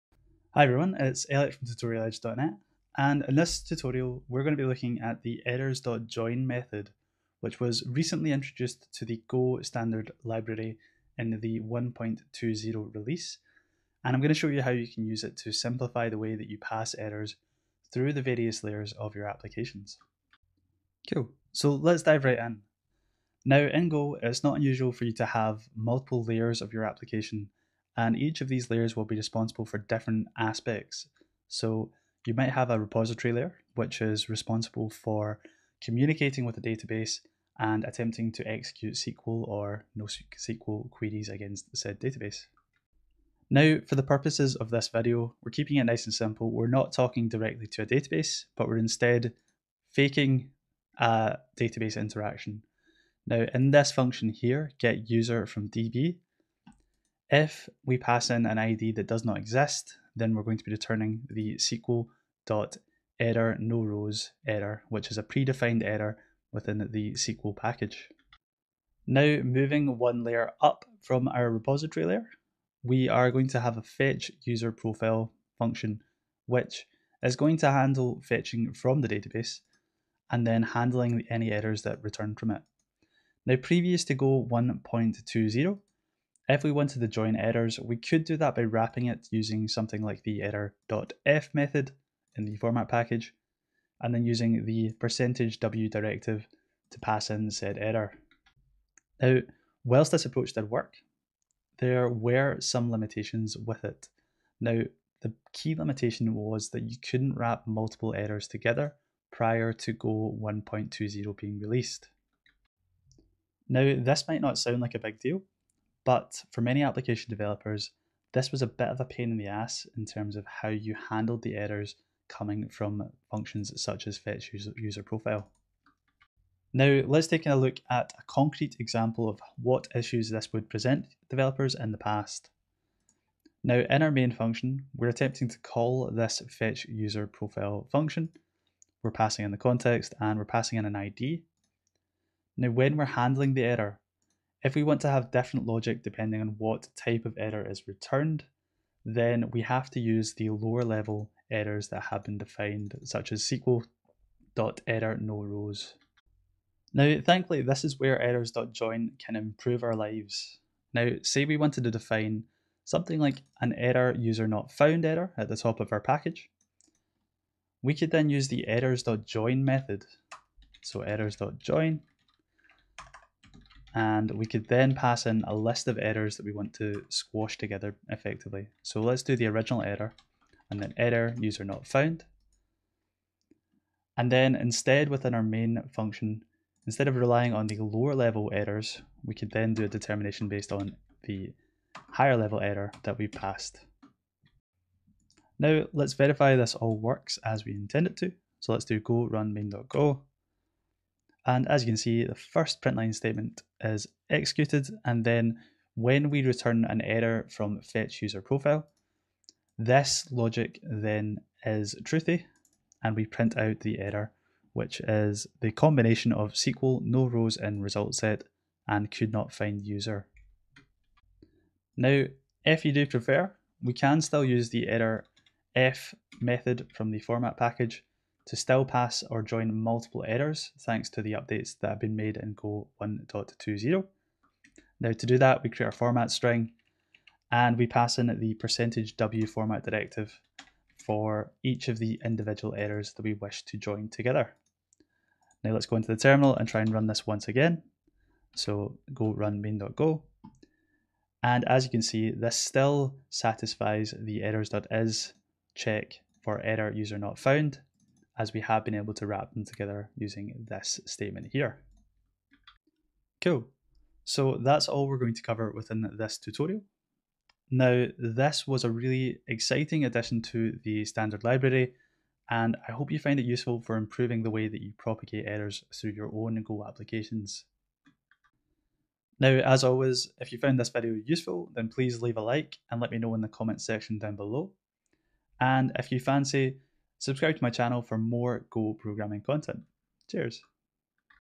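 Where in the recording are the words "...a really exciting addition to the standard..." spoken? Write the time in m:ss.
4:28.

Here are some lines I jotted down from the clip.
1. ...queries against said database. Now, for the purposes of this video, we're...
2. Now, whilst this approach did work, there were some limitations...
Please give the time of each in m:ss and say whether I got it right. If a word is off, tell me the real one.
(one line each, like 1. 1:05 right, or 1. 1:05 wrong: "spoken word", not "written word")
1. 0:40 right
2. 1:39 right.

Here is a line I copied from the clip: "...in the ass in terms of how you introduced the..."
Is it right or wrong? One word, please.
wrong.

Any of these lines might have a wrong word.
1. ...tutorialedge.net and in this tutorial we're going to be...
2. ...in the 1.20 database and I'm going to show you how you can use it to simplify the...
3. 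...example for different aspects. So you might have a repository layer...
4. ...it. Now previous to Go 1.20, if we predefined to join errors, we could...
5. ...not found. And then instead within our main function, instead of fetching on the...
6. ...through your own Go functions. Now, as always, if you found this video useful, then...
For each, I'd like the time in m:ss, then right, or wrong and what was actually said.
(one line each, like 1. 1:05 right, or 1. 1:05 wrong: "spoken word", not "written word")
1. 0:01 right
2. 0:11 wrong: "release", not "database"
3. 0:29 wrong: "responsible", not "example"
4. 1:22 wrong: "wanted", not "predefined"
5. 3:01 wrong: "relying", not "fetching"
6. 4:35 wrong: "applications", not "functions".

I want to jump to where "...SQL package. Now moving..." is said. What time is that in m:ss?
1:07.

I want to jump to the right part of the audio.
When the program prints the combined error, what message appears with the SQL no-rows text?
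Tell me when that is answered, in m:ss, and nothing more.
3:39.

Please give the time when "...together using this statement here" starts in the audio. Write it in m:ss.
4:19.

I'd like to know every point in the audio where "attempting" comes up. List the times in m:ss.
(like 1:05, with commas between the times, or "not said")
0:37, 2:15.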